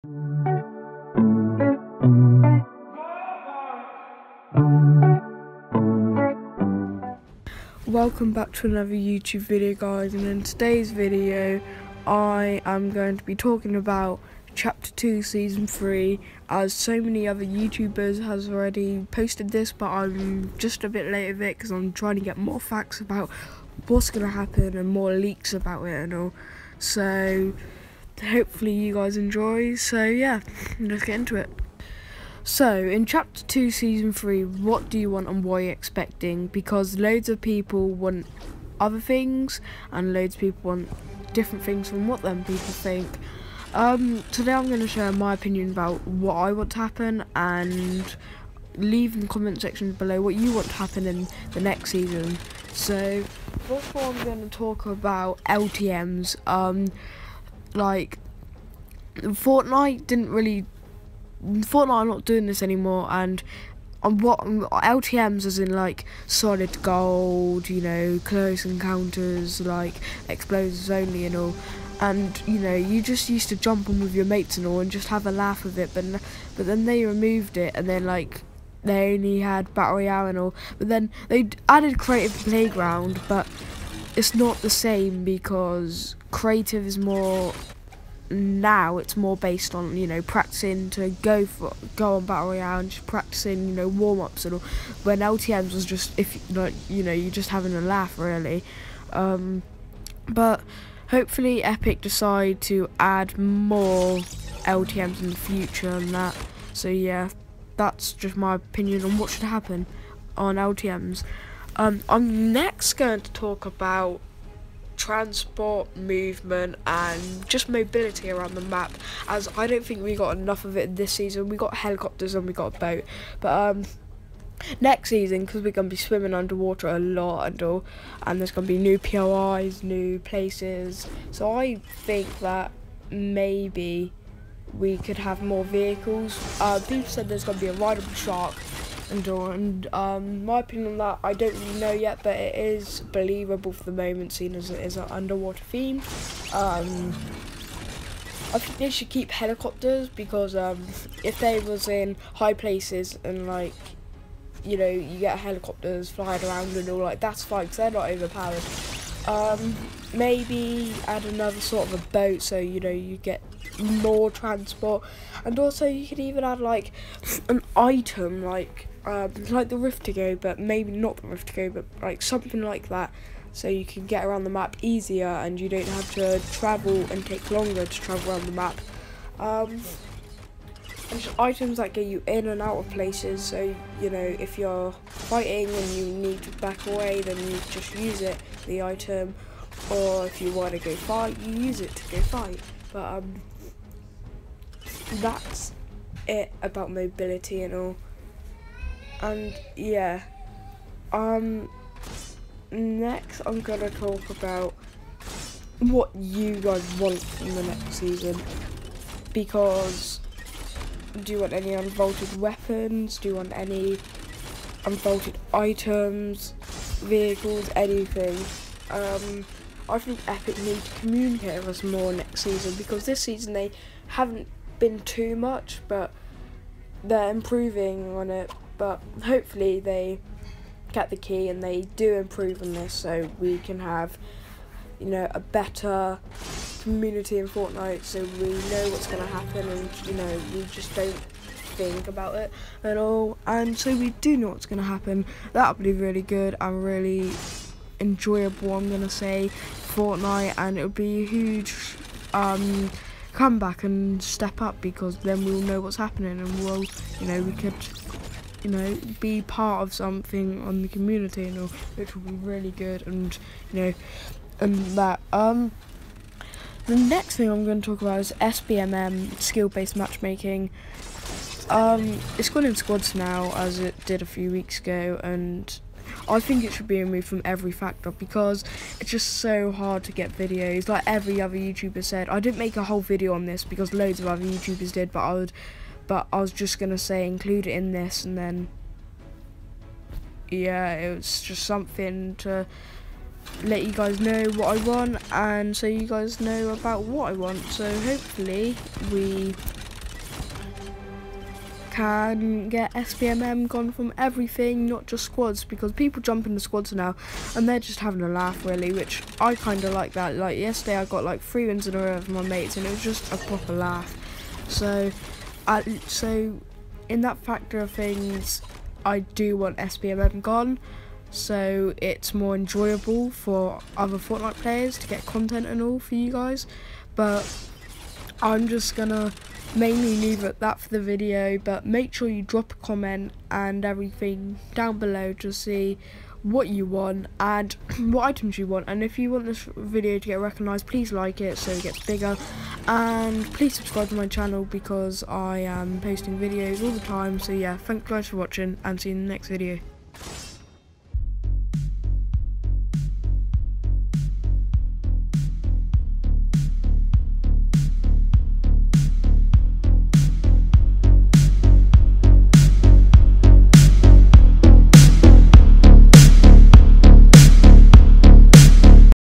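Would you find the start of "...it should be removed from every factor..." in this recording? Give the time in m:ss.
4:36.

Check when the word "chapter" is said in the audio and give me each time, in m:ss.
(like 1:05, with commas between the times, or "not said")
0:14, 0:33.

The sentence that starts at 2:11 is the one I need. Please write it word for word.
So I think that maybe we could have more vehicles.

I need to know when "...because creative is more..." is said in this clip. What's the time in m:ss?
1:25.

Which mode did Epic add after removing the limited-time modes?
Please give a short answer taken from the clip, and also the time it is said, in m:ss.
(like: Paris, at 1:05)
creative playground, at 1:21.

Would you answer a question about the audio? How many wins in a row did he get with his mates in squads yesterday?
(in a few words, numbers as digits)
3.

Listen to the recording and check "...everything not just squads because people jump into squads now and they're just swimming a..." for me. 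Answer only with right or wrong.
wrong.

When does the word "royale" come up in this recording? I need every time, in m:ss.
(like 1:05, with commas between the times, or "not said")
1:19, 1:32.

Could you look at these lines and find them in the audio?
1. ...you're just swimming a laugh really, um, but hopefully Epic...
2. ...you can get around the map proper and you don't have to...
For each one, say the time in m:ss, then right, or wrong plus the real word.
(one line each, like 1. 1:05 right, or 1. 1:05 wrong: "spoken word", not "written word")
1. 1:37 wrong: "having", not "swimming"
2. 2:53 wrong: "easier", not "proper".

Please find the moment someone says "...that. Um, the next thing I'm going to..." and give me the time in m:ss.
4:24.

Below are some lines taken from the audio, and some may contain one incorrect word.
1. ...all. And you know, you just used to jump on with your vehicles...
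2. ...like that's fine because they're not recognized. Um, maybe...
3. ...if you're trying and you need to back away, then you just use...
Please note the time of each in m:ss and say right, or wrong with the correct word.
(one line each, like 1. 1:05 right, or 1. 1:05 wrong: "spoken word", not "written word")
1. 1:11 wrong: "mates", not "vehicles"
2. 2:36 wrong: "overpowered", not "recognized"
3. 3:04 wrong: "fighting", not "trying".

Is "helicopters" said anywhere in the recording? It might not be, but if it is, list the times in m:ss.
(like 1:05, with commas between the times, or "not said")
2:01, 2:29, 2:35.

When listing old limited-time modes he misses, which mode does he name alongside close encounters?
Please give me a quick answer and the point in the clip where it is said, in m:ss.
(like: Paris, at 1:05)
solid gold, at 1:06.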